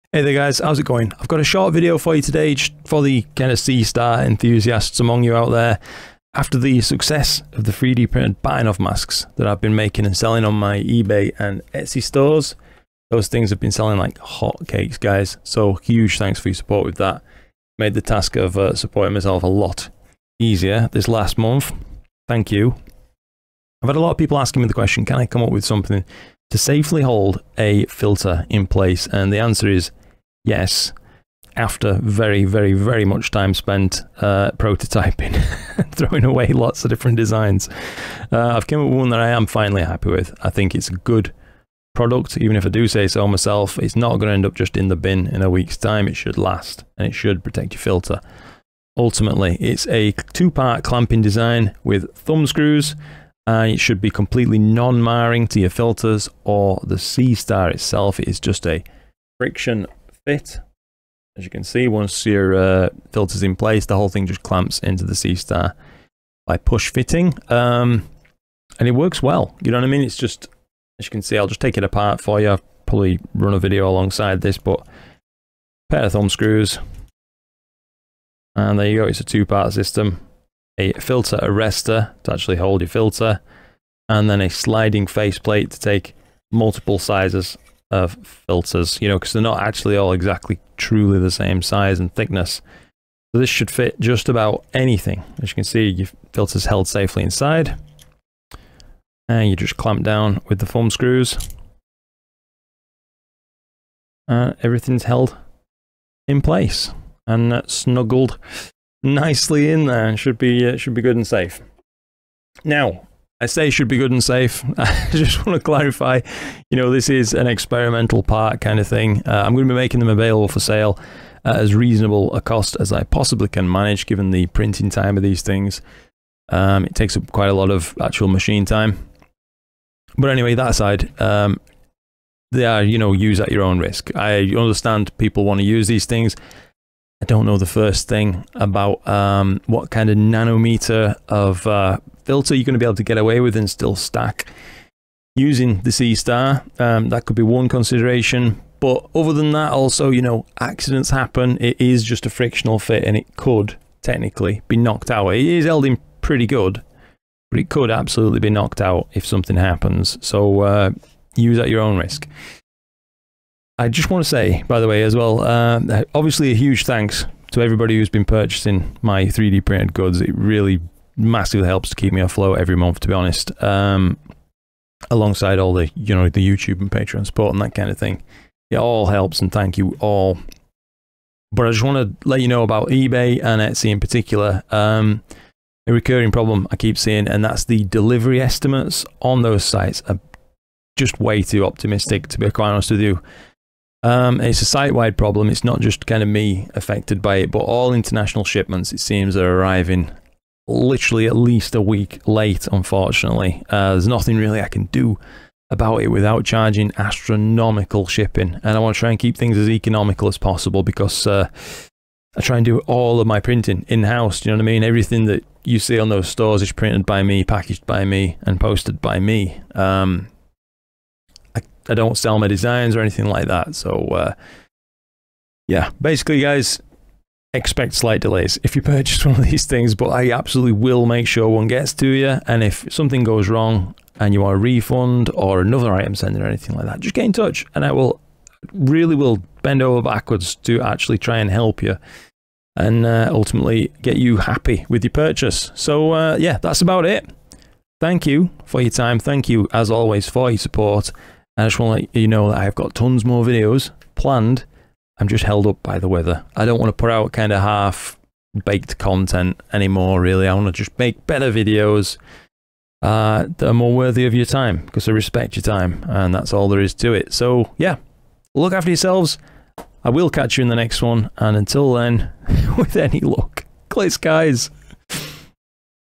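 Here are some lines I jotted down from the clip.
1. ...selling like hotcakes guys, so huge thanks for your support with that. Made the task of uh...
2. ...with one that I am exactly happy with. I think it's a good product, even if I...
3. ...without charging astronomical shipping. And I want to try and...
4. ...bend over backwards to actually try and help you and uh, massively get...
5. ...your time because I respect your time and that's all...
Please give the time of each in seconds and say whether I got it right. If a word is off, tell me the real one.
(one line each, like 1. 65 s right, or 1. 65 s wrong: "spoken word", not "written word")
1. 13 s right
2. 38 s wrong: "finally", not "exactly"
3. 206 s right
4. 239 s wrong: "ultimately", not "massively"
5. 264 s right.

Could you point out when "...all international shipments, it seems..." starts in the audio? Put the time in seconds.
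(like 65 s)
197 s.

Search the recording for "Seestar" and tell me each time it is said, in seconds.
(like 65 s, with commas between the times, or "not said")
3 s, 56 s, 65 s, 145 s.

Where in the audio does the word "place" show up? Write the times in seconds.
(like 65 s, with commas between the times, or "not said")
28 s, 63 s, 106 s.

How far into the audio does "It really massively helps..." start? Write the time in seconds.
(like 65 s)
170 s.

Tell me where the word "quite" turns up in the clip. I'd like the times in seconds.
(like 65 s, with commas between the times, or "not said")
127 s, 192 s.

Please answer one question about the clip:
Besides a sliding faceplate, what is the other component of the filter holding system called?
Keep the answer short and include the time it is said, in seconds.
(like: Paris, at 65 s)
Filter arrestor, at 80 s.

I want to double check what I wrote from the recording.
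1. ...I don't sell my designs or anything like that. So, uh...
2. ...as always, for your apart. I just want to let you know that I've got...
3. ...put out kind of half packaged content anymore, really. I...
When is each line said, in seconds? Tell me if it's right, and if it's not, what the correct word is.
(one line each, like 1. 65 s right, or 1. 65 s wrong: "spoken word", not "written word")
1. 221 s right
2. 249 s wrong: "support", not "apart"
3. 256 s wrong: "baked", not "packaged".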